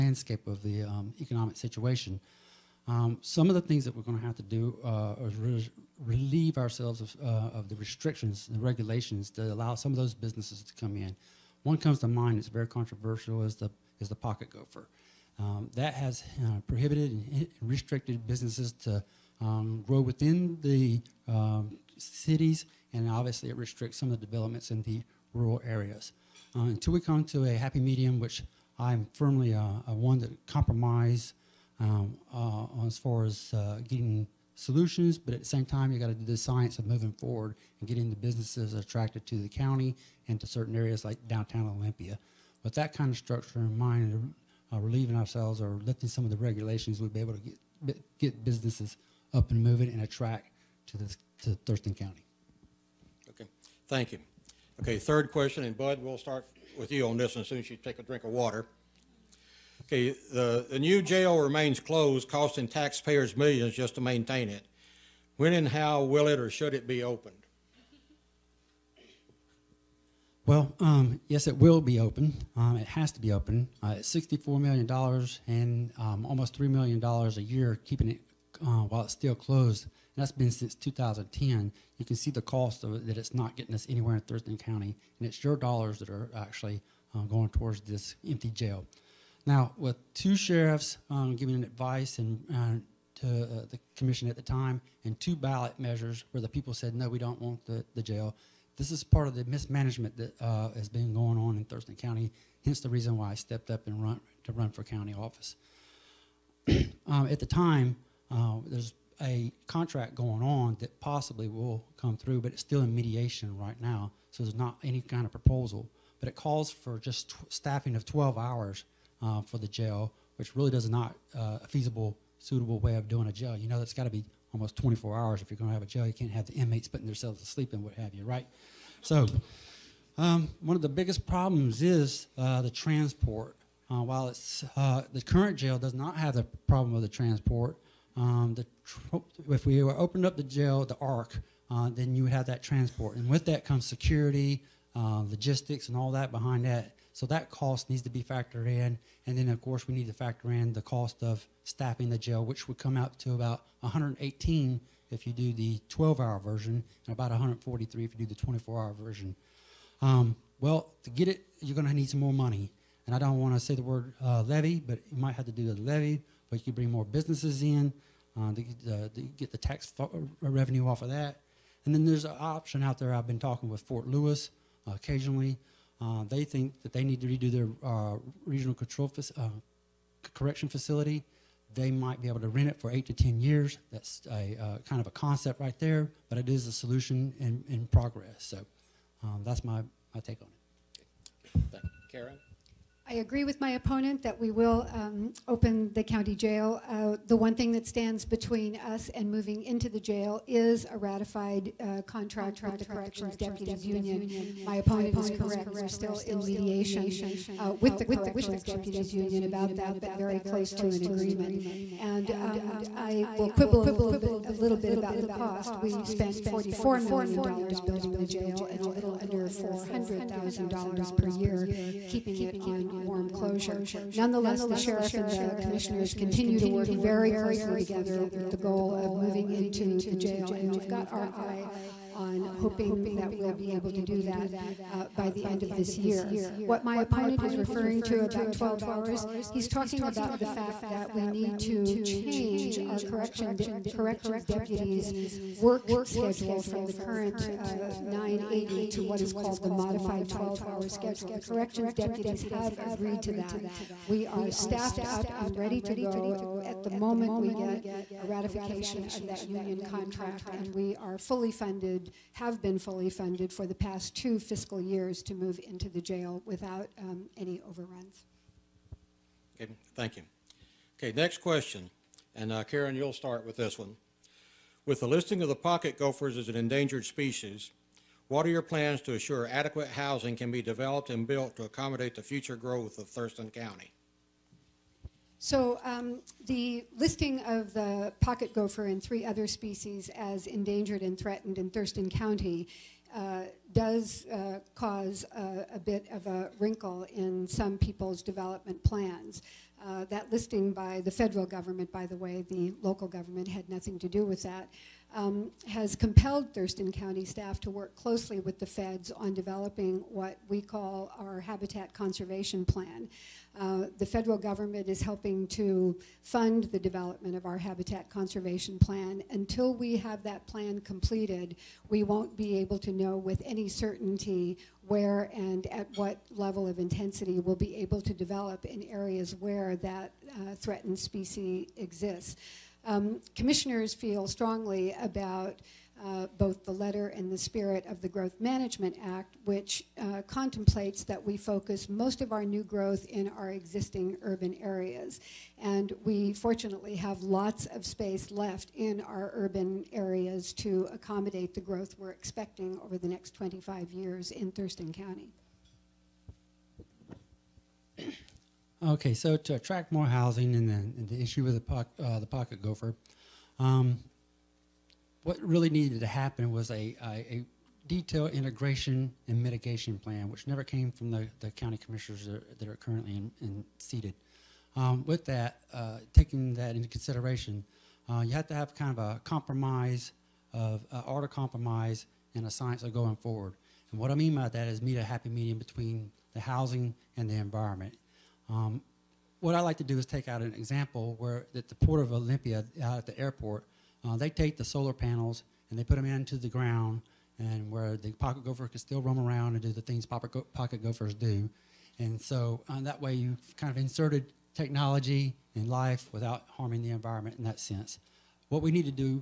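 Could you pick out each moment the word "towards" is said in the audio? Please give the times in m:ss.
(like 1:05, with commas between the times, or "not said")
1:27.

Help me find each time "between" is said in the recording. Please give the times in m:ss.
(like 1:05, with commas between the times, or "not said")
3:18, 6:25.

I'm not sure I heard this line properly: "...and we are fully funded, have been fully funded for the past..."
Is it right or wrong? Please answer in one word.
right.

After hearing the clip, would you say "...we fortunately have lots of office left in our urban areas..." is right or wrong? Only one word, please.
wrong.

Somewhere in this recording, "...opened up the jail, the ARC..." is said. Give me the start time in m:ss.
2:19.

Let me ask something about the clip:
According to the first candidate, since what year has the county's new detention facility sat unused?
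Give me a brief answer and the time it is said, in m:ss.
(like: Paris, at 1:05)
2010, at 1:20.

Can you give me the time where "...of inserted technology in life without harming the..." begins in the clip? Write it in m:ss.
6:43.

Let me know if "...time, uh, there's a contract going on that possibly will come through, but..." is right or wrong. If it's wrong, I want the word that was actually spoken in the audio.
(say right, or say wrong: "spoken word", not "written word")
right.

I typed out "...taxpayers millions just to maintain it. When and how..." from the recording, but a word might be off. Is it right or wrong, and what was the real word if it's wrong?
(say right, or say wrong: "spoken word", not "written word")
right.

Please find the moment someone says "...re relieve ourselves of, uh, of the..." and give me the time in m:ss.
0:05.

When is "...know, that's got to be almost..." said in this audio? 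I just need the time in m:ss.
2:03.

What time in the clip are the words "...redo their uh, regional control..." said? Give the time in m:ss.
2:57.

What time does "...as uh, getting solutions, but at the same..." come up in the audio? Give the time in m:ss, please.
0:33.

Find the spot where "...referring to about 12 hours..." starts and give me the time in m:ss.
3:57.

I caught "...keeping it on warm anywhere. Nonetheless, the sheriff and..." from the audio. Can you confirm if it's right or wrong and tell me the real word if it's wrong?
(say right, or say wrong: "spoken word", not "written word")
wrong: "closure", not "anywhere".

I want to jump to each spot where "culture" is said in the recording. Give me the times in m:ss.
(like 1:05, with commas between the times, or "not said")
not said.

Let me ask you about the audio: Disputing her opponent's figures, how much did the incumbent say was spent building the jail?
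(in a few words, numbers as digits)
$44 million.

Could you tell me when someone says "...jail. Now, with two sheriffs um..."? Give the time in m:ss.
1:28.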